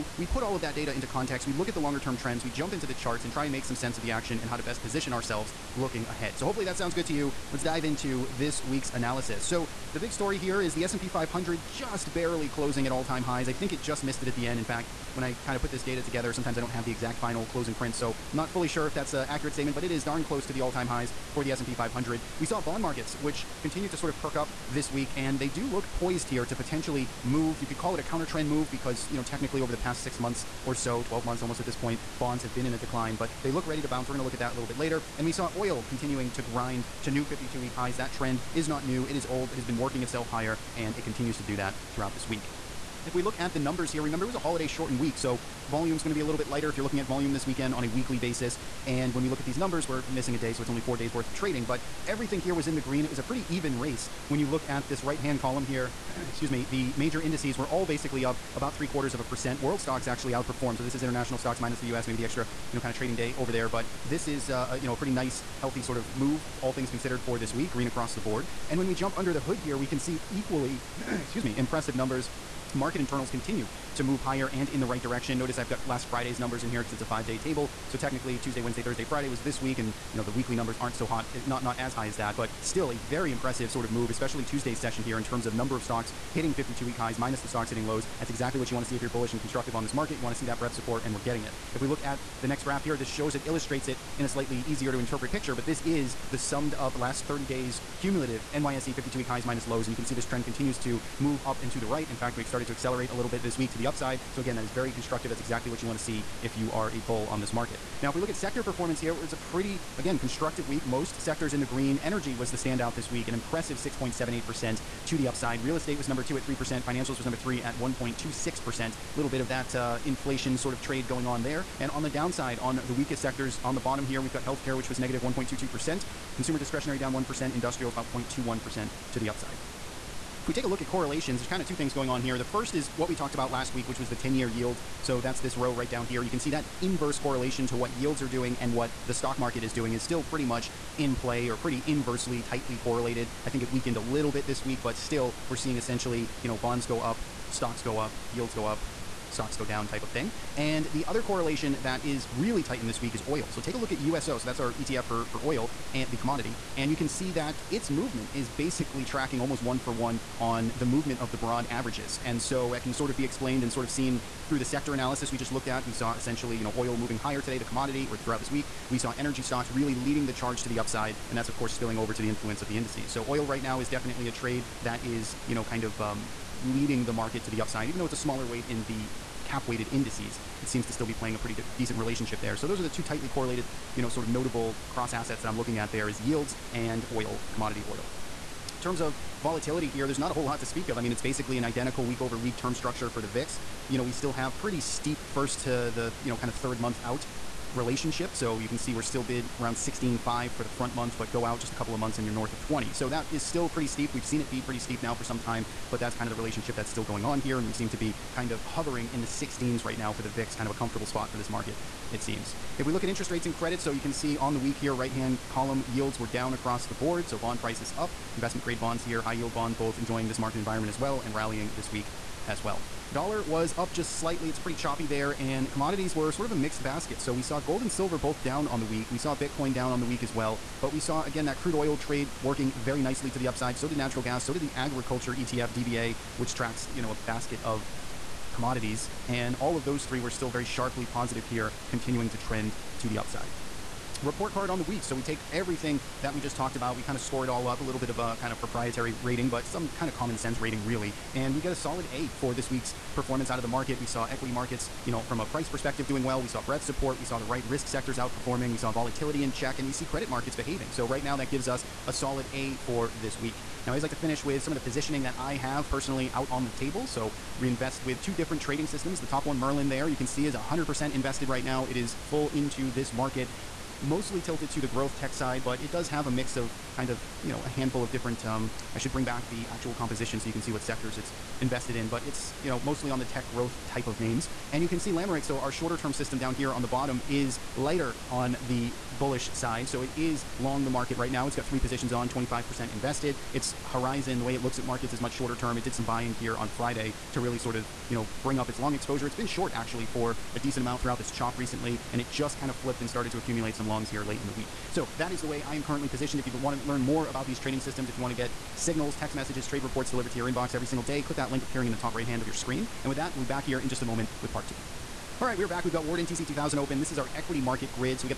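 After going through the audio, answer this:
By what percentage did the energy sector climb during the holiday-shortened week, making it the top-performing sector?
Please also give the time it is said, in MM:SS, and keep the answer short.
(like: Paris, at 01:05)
6.78%, at 01:53.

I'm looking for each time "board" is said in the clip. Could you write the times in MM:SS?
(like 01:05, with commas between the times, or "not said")
01:08, 03:36.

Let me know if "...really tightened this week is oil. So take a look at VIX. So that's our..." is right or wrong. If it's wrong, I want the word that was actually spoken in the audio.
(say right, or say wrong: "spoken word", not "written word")
wrong: "USO", not "VIX".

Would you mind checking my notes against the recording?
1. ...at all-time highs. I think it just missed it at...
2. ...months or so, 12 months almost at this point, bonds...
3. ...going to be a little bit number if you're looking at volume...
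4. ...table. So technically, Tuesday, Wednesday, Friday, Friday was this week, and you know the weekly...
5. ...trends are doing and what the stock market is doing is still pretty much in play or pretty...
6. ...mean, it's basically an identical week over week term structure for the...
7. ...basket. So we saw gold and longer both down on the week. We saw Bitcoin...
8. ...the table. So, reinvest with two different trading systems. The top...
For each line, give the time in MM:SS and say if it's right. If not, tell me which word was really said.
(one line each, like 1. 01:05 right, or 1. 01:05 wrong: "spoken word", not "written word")
1. 00:12 right
2. 00:30 right
3. 00:46 wrong: "lighter", not "number"
4. 01:17 wrong: "Thursday", not "Friday"
5. 02:17 wrong: "yields", not "trends"
6. 03:11 right
7. 03:46 wrong: "silver", not "longer"
8. 04:26 right.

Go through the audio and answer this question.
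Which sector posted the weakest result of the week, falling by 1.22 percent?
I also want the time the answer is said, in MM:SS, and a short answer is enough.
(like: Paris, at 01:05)
Healthcare, at 02:04.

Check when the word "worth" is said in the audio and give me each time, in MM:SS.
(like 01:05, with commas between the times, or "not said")
00:51.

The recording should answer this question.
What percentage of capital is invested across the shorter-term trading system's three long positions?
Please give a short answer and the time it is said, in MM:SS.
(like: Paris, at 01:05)
25%, at 04:52.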